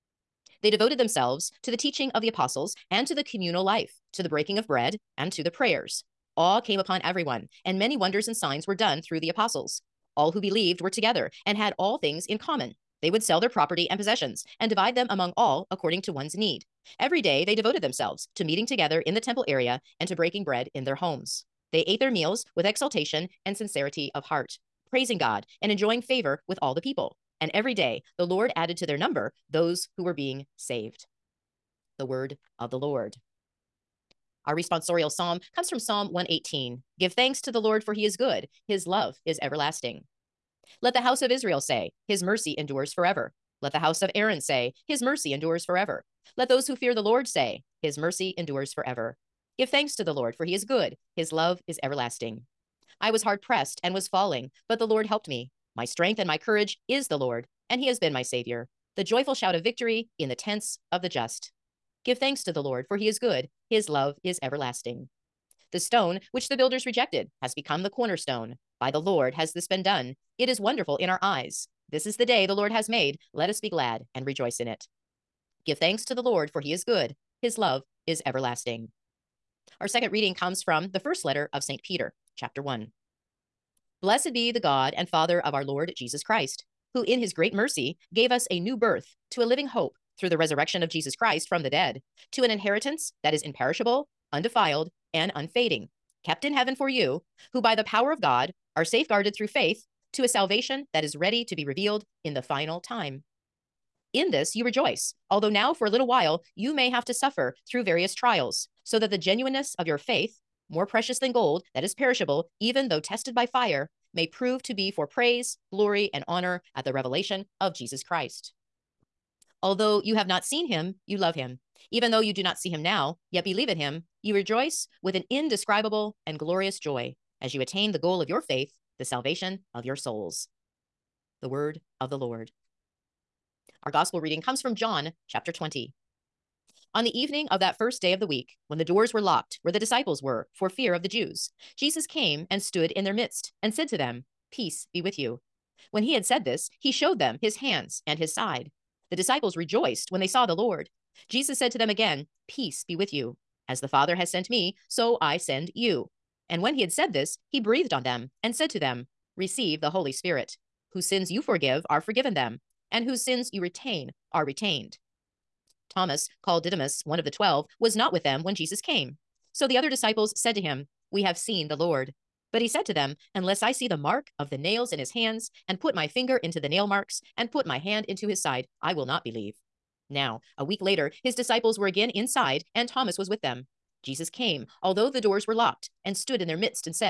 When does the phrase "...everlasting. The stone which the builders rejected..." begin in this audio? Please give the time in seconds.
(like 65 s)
64 s.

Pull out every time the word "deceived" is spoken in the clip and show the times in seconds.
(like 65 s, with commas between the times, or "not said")
not said.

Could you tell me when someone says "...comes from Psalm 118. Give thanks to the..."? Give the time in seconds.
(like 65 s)
35 s.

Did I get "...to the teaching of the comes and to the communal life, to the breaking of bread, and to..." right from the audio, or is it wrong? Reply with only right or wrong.
wrong.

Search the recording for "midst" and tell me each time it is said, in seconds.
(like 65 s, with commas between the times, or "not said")
143 s, 186 s.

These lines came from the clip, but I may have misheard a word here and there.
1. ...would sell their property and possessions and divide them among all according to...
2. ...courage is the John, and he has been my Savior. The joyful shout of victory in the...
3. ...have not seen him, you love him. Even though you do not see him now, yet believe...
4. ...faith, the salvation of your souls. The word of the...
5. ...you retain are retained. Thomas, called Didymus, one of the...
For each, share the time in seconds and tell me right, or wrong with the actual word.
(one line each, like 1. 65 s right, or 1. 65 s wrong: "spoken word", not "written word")
1. 13 s right
2. 56 s wrong: "Lord", not "John"
3. 120 s right
4. 128 s right
5. 163 s right.